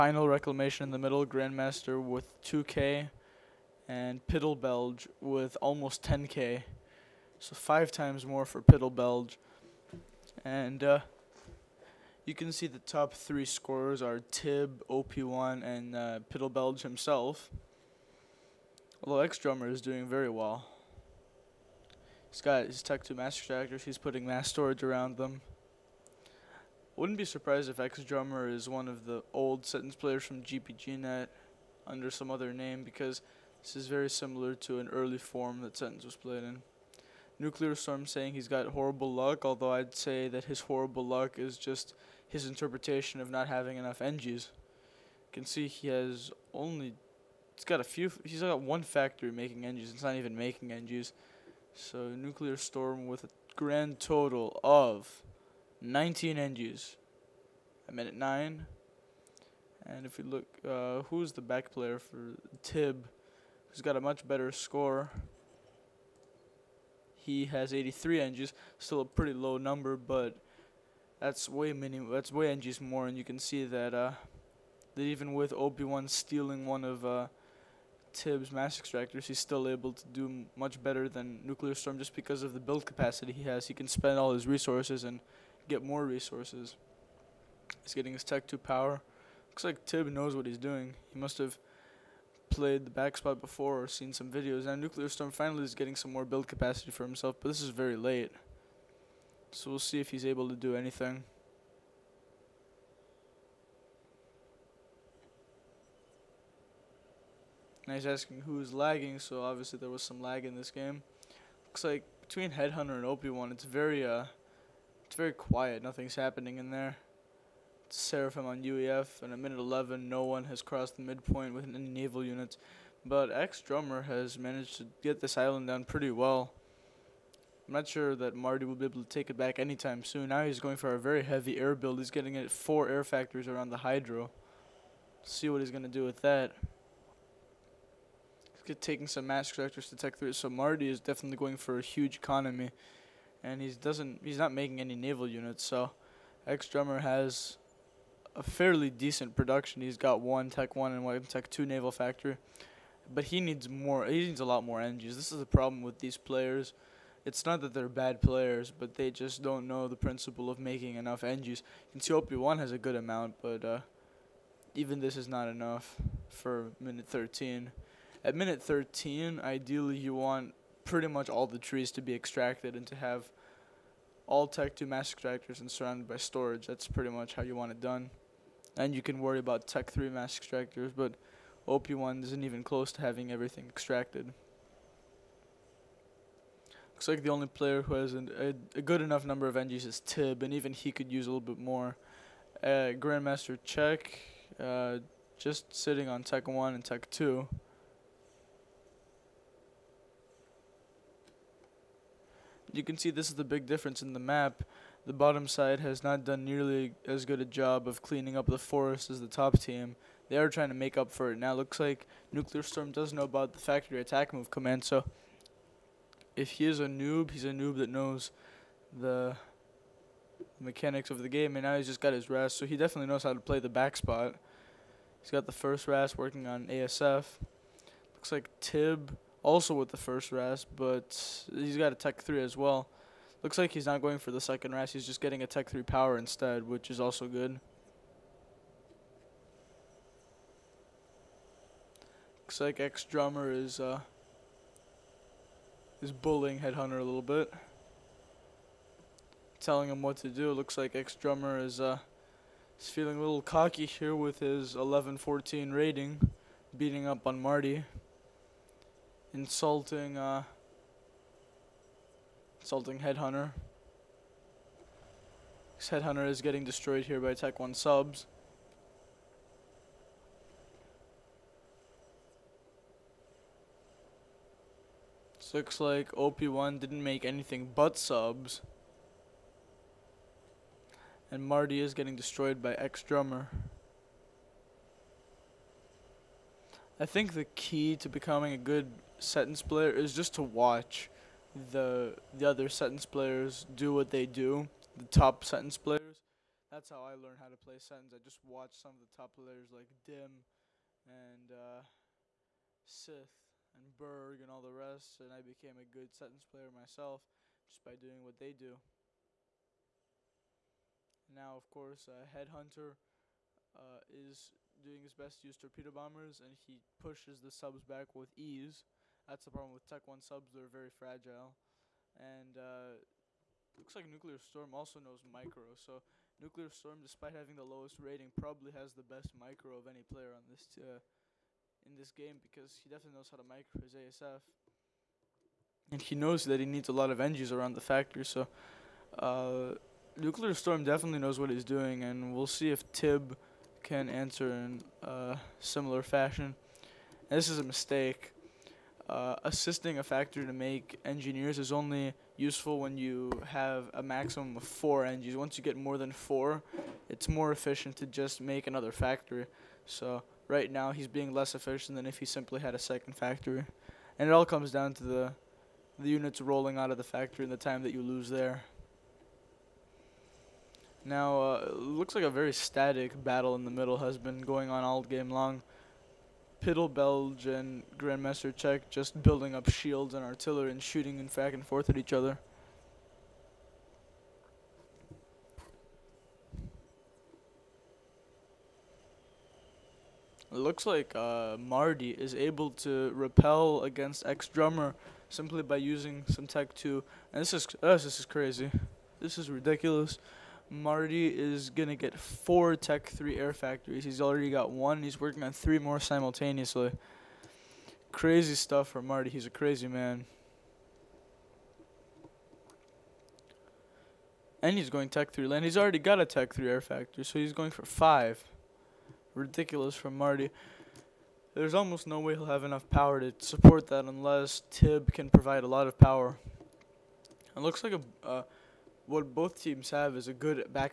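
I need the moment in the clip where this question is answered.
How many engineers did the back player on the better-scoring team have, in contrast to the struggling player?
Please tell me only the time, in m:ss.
1:07.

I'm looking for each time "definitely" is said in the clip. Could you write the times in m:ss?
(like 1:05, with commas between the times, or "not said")
2:21, 3:42, 5:32, 5:40.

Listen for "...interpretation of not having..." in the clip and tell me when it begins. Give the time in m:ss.
0:42.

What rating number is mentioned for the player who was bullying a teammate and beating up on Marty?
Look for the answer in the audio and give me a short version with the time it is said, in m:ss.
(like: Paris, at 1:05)
1114, at 4:14.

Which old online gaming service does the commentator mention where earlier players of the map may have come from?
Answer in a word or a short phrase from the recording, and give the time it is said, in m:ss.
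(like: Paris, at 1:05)
GPGNet, at 0:30.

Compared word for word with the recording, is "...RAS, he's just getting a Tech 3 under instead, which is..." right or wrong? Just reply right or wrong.
wrong.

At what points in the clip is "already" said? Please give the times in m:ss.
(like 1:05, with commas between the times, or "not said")
6:44, 6:55.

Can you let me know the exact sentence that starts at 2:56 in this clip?
That's pretty much how you want it done.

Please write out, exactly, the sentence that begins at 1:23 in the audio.
He can spend all his resources and get more resources.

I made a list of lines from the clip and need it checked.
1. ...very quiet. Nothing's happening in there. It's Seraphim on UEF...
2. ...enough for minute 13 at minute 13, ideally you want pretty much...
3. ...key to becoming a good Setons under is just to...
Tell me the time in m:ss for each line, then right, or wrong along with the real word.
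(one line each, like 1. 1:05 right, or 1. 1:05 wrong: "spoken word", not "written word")
1. 1:55 right
2. 2:45 right
3. 4:47 wrong: "player", not "under".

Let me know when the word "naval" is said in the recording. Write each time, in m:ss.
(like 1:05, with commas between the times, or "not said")
2:01, 2:24, 2:31.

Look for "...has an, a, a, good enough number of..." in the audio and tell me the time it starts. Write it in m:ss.
3:07.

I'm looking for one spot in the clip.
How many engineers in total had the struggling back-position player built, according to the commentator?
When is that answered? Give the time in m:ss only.
0:55.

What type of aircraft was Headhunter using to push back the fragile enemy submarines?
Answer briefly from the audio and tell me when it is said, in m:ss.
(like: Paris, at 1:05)
torpedo bombers, at 5:15.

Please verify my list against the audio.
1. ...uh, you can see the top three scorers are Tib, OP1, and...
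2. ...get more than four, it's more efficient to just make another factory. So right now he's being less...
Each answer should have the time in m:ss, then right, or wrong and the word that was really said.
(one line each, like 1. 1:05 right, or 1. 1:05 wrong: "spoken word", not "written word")
1. 0:10 right
2. 5:55 right.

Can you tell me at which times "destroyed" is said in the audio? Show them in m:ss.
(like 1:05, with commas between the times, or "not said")
4:26, 4:42.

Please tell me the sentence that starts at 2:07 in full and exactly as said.
I'm not sure that Marty will be able to take it back anytime soon.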